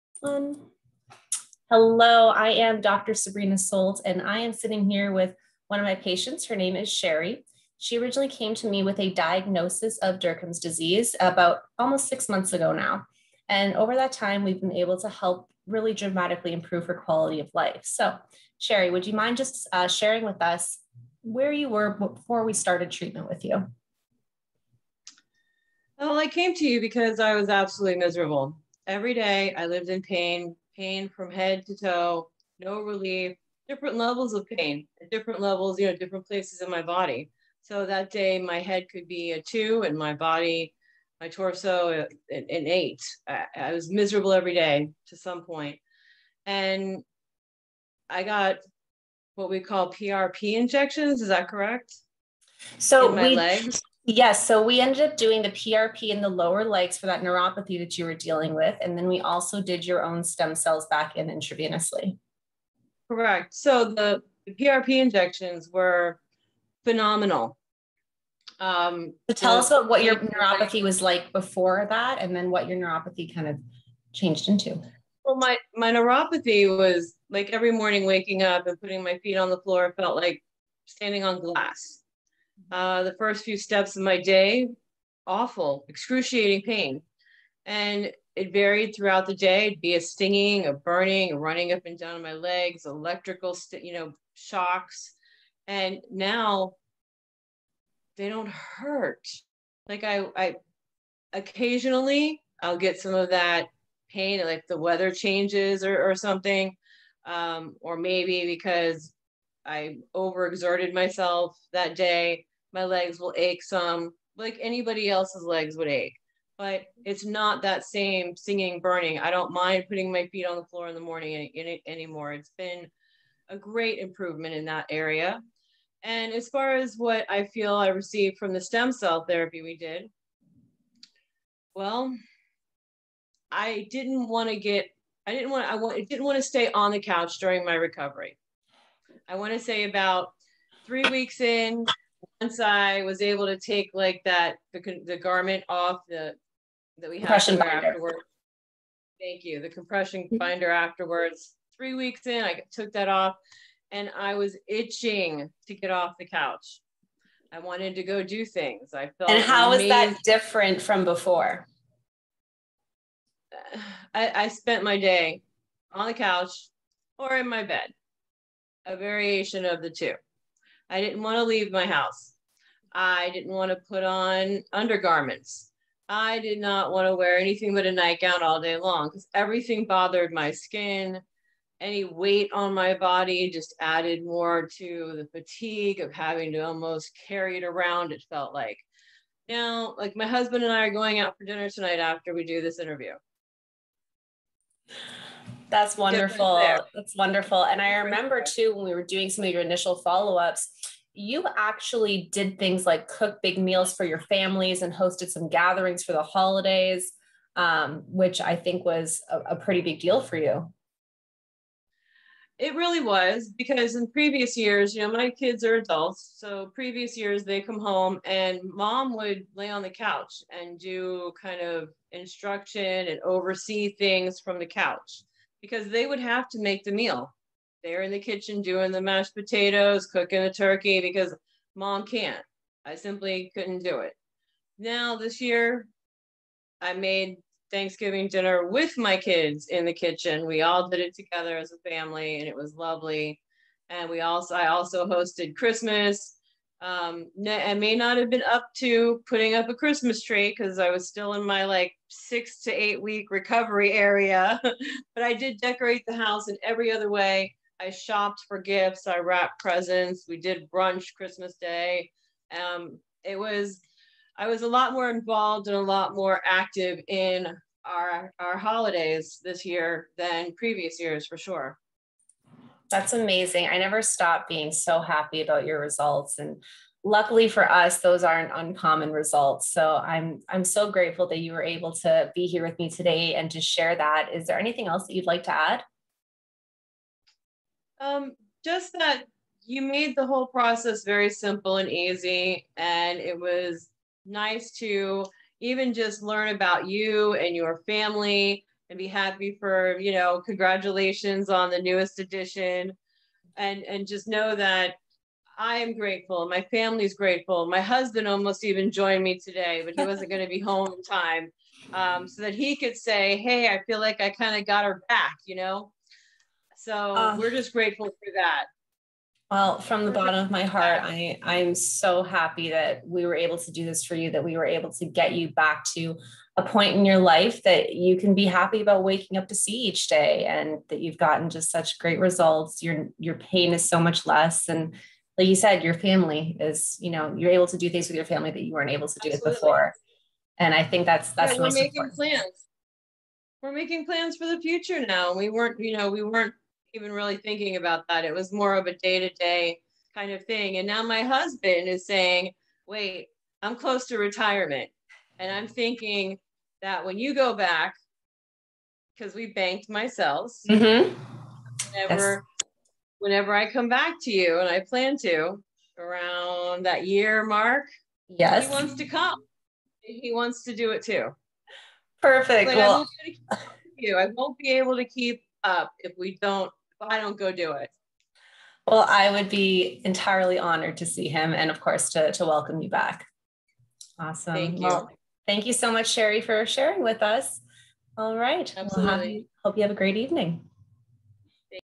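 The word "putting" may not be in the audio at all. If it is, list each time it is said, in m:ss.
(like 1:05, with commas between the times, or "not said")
1:18, 1:59, 4:09.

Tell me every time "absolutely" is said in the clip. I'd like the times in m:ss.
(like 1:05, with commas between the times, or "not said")
0:27, 5:39, 6:28.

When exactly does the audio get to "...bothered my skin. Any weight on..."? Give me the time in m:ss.
2:59.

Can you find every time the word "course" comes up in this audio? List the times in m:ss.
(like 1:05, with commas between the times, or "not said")
6:21.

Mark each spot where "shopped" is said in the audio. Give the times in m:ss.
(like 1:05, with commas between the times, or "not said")
4:17.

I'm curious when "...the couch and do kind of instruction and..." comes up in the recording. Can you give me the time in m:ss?
3:39.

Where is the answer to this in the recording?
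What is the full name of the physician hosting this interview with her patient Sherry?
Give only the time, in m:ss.
0:03.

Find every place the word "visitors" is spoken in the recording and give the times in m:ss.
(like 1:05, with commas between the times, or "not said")
not said.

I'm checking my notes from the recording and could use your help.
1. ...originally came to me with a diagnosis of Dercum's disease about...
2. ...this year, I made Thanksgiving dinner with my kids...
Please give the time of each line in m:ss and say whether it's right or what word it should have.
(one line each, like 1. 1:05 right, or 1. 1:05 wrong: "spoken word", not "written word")
1. 0:07 right
2. 3:55 right.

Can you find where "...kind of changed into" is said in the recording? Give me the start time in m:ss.
1:13.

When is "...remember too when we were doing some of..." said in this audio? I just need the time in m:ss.
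3:17.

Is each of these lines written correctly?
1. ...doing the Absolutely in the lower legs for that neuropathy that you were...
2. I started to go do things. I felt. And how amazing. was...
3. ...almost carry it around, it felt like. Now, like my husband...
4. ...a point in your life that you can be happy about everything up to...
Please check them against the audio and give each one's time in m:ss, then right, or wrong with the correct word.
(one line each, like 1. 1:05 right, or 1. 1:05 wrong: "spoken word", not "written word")
1. 0:55 wrong: "PRP", not "Absolutely"
2. 2:37 wrong: "wanted", not "started"
3. 3:06 right
4. 5:26 wrong: "waking", not "everything".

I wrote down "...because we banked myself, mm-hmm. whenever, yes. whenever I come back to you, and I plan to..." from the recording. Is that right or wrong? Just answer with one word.
right.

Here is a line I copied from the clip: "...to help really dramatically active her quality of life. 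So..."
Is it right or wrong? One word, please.
wrong.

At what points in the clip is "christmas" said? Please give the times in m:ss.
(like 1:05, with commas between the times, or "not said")
4:05, 4:09, 4:21.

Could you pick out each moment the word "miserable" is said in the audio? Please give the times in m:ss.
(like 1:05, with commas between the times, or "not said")
0:27, 0:43.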